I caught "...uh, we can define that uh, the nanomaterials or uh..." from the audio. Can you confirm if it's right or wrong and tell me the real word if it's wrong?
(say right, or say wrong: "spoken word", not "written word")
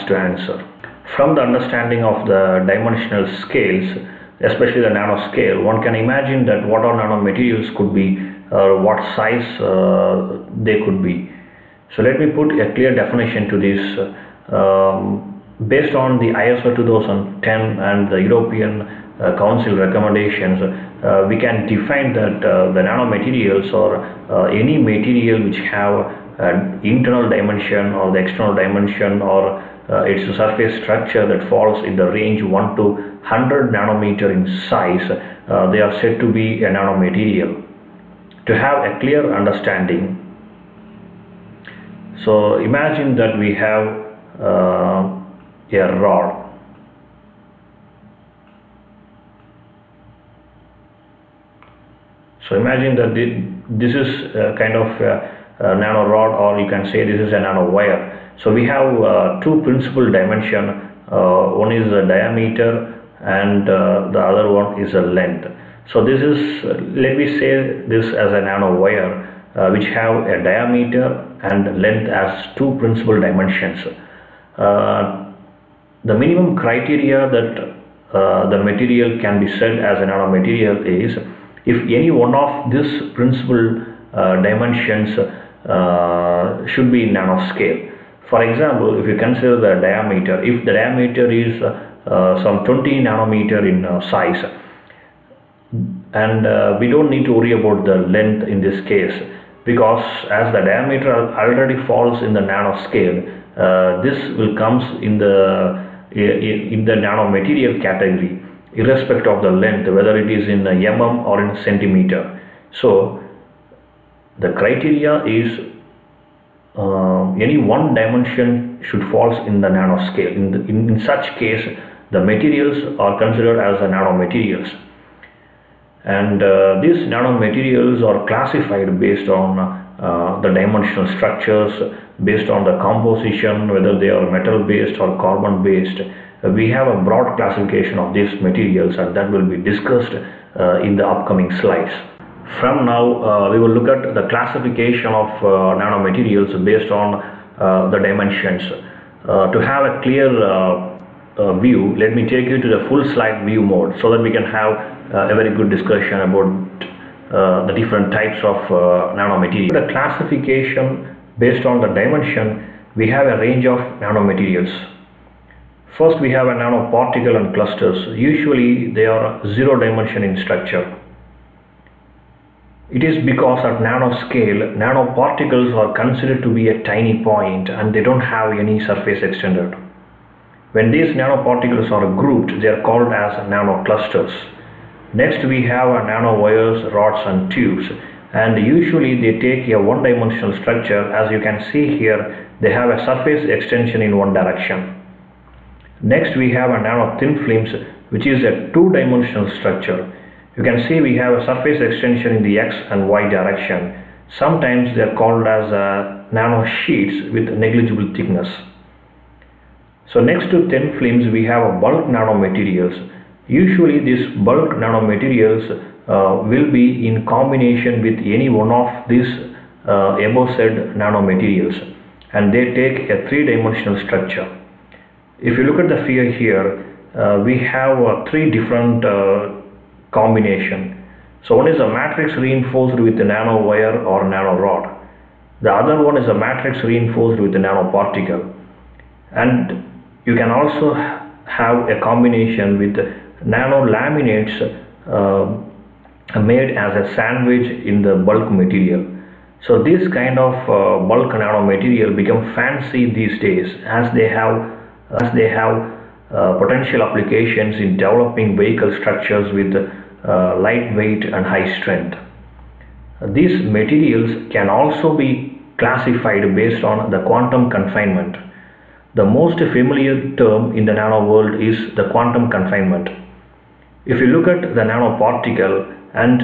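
right.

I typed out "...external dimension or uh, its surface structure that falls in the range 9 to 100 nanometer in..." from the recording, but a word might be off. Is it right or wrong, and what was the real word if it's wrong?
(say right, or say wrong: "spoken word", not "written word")
wrong: "1", not "9".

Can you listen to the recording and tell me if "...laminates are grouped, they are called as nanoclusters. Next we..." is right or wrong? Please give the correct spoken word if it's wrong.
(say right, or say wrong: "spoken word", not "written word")
wrong: "nanoparticles", not "laminates".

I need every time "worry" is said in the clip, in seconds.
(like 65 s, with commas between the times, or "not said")
97 s.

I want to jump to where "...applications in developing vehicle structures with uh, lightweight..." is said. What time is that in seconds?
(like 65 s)
257 s.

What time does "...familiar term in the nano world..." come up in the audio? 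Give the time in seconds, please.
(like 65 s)
269 s.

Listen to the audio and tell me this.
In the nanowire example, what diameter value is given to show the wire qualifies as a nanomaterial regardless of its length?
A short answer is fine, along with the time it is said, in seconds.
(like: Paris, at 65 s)
20 nanometers, at 92 s.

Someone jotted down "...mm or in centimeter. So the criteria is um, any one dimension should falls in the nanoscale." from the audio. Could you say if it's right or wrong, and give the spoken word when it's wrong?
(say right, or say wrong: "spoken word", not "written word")
right.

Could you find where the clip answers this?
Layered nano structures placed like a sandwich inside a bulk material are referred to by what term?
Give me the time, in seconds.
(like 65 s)
243 s.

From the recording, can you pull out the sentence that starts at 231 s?
So one is a matrix reinforced with a nanowire or nanorod.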